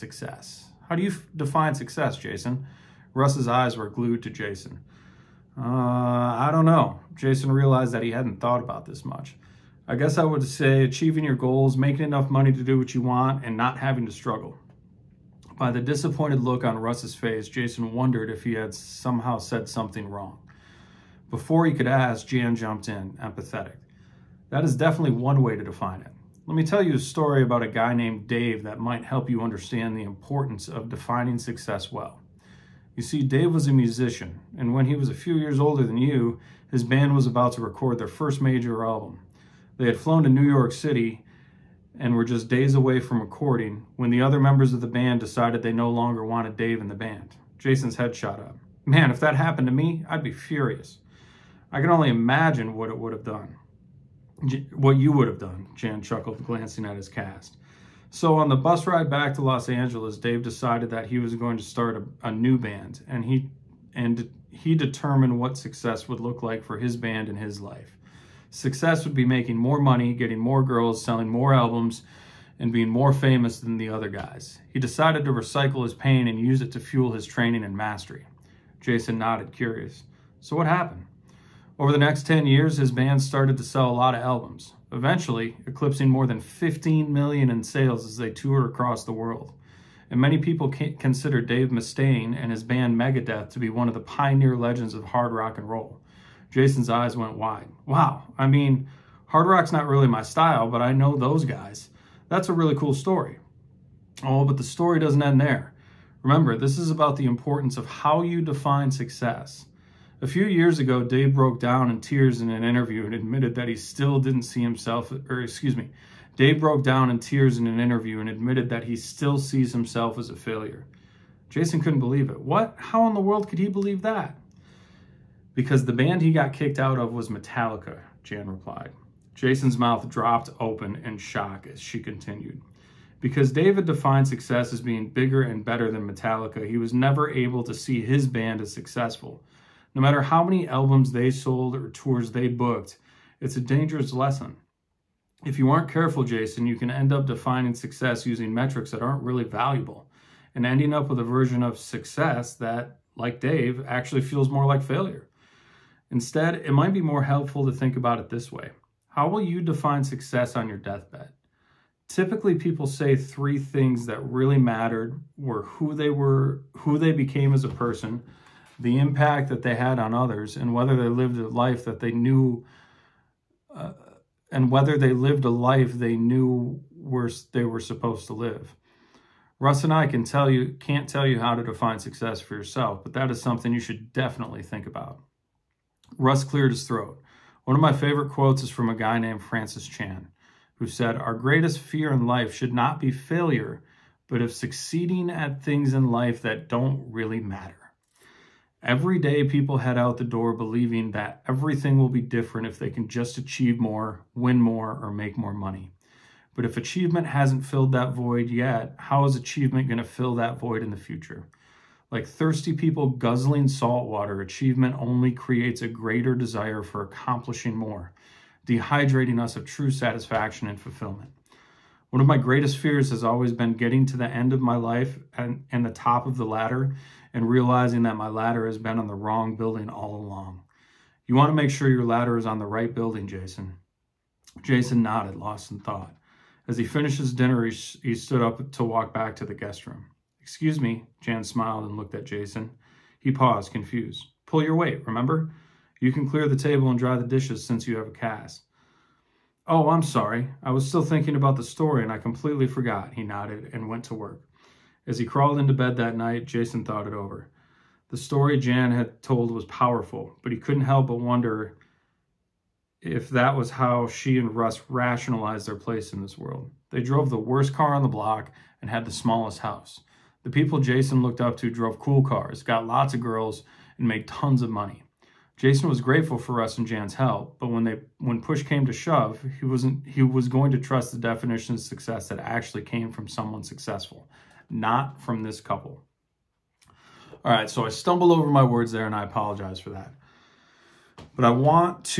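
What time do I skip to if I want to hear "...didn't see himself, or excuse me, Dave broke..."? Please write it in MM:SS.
01:54.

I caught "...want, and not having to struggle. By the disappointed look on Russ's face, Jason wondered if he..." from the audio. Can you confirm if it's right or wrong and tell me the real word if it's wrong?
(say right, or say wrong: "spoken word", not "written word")
right.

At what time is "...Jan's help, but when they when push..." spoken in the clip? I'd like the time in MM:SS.
04:36.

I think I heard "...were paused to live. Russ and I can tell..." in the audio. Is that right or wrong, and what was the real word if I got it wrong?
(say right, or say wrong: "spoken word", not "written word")
wrong: "supposed", not "paused".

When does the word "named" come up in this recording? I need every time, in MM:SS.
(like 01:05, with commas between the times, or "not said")
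00:27, 03:09.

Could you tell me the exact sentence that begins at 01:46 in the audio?
Remember, this is about the importance of how you define success.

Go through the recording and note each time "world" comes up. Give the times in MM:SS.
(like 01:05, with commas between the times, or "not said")
01:29, 02:03, 04:26.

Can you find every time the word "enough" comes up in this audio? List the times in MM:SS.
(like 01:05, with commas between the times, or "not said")
00:12.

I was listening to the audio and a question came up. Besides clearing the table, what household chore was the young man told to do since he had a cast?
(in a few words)
dry the dishes.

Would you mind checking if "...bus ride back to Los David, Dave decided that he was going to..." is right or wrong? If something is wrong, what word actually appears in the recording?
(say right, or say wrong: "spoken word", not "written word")
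wrong: "Angeles", not "David".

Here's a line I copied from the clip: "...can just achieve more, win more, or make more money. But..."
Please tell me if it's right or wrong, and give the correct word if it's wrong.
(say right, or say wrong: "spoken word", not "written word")
right.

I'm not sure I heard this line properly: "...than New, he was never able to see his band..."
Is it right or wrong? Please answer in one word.
wrong.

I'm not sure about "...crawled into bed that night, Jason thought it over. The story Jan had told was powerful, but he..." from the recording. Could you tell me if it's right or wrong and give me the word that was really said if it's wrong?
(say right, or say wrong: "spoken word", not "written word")
right.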